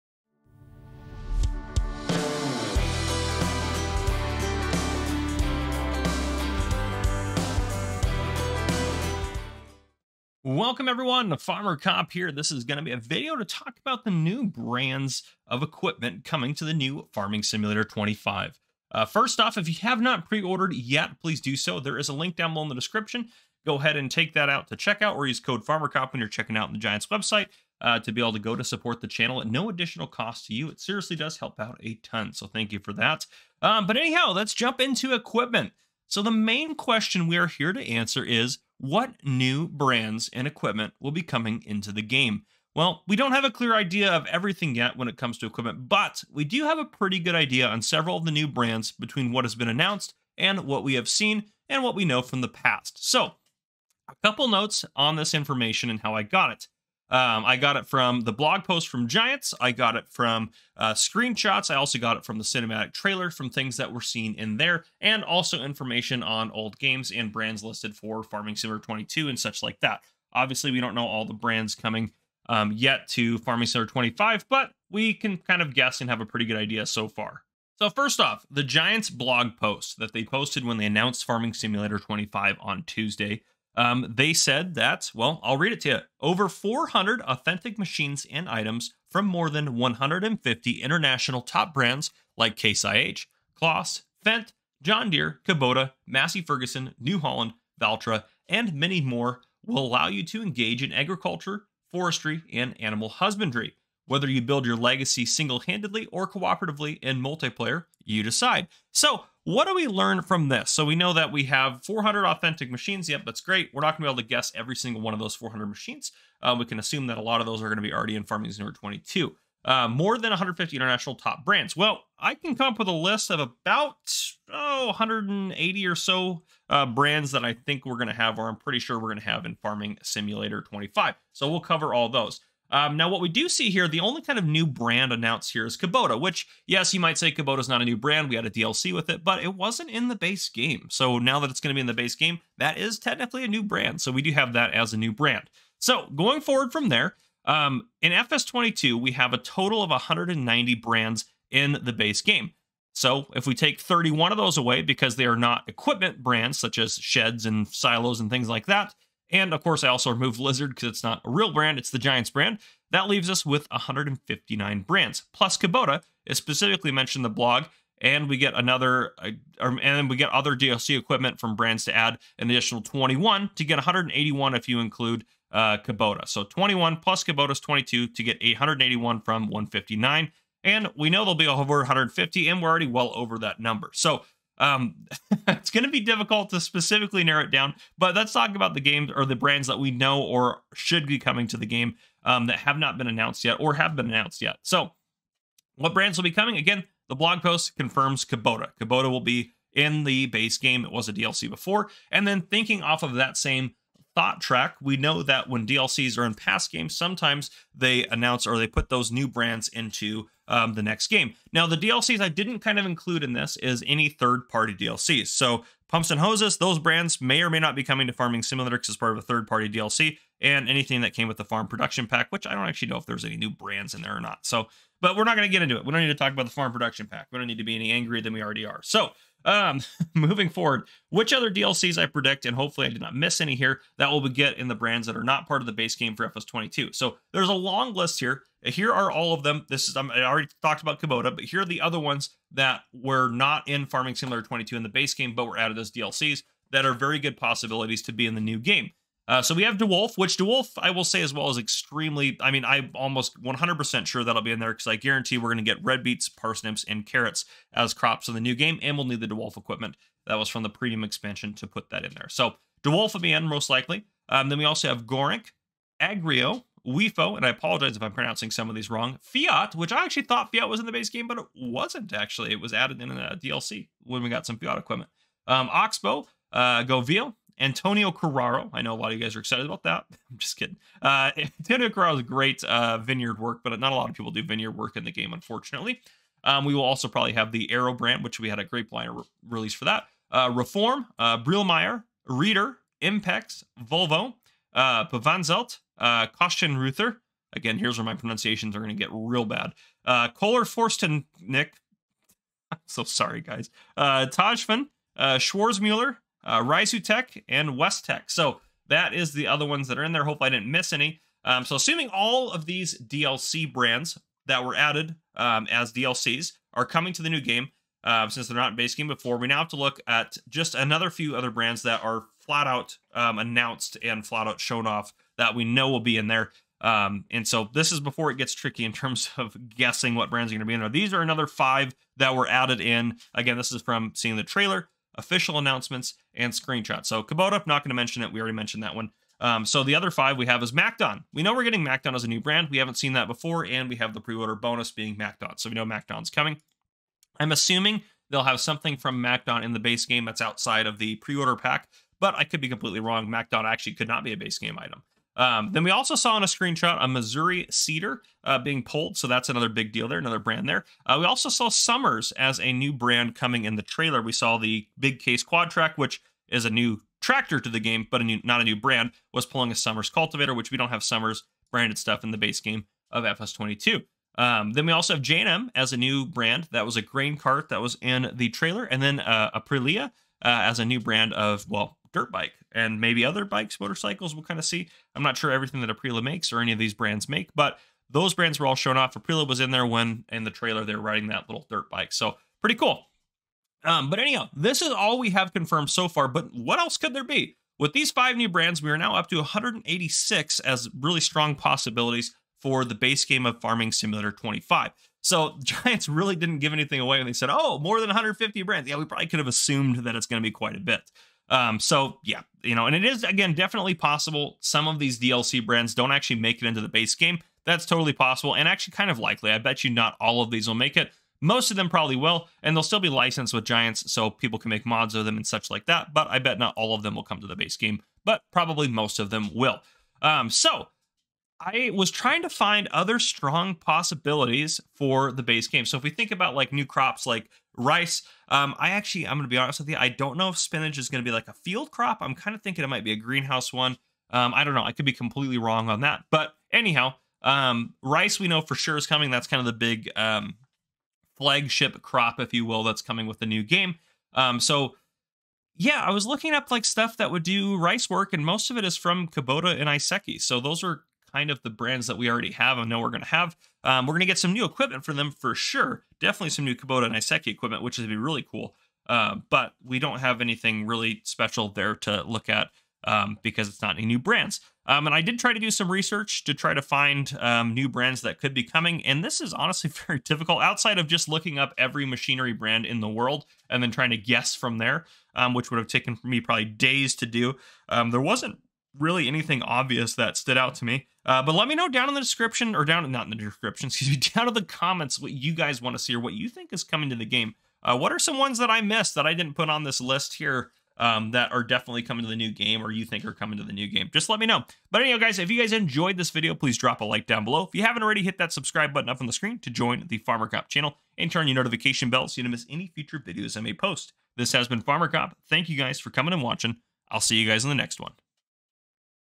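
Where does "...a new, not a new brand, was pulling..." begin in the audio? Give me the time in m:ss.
6:08.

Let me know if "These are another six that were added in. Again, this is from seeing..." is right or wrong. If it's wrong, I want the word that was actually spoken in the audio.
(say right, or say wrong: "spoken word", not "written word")
wrong: "five", not "six".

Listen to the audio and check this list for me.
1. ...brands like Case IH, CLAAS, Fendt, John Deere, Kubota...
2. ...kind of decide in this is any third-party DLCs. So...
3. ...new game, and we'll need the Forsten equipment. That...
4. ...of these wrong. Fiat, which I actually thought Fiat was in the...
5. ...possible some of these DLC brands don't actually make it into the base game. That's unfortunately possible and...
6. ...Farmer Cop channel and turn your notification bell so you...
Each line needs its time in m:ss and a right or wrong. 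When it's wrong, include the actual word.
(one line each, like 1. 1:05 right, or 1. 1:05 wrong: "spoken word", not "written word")
1. 1:31 right
2. 3:32 wrong: "include", not "decide"
3. 4:18 wrong: "Dewulf", not "Forsten"
4. 4:28 right
5. 6:53 wrong: "totally", not "unfortunately"
6. 8:30 right.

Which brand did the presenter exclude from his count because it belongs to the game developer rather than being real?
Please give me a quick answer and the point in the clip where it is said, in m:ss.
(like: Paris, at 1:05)
Lizard, at 2:40.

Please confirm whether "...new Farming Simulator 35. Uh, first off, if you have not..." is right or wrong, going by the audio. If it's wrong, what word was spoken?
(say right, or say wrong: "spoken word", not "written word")
wrong: "25", not "35".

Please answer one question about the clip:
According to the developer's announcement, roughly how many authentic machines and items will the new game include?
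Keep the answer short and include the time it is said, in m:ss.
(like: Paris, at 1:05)
Over 400, at 1:26.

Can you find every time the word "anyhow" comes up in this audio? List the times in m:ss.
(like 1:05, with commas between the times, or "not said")
0:33, 6:34, 7:26.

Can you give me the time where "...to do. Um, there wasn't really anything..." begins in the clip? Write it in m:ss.
8:07.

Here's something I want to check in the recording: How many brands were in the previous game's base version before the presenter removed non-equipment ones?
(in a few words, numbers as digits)
190.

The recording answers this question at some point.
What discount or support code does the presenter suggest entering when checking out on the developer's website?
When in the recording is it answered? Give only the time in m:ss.
0:25.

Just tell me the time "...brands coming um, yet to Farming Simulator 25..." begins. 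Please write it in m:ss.
1:11.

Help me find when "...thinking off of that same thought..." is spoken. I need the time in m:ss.
3:22.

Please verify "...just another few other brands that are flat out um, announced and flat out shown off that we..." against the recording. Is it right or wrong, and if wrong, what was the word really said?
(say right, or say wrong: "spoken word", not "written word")
right.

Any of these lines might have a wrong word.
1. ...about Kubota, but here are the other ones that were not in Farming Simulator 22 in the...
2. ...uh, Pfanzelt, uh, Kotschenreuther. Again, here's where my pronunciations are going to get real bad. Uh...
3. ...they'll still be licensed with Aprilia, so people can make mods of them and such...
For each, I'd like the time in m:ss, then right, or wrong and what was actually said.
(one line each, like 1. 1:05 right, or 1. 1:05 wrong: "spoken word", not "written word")
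1. 4:00 right
2. 4:54 right
3. 7:02 wrong: "Giants", not "Aprilia".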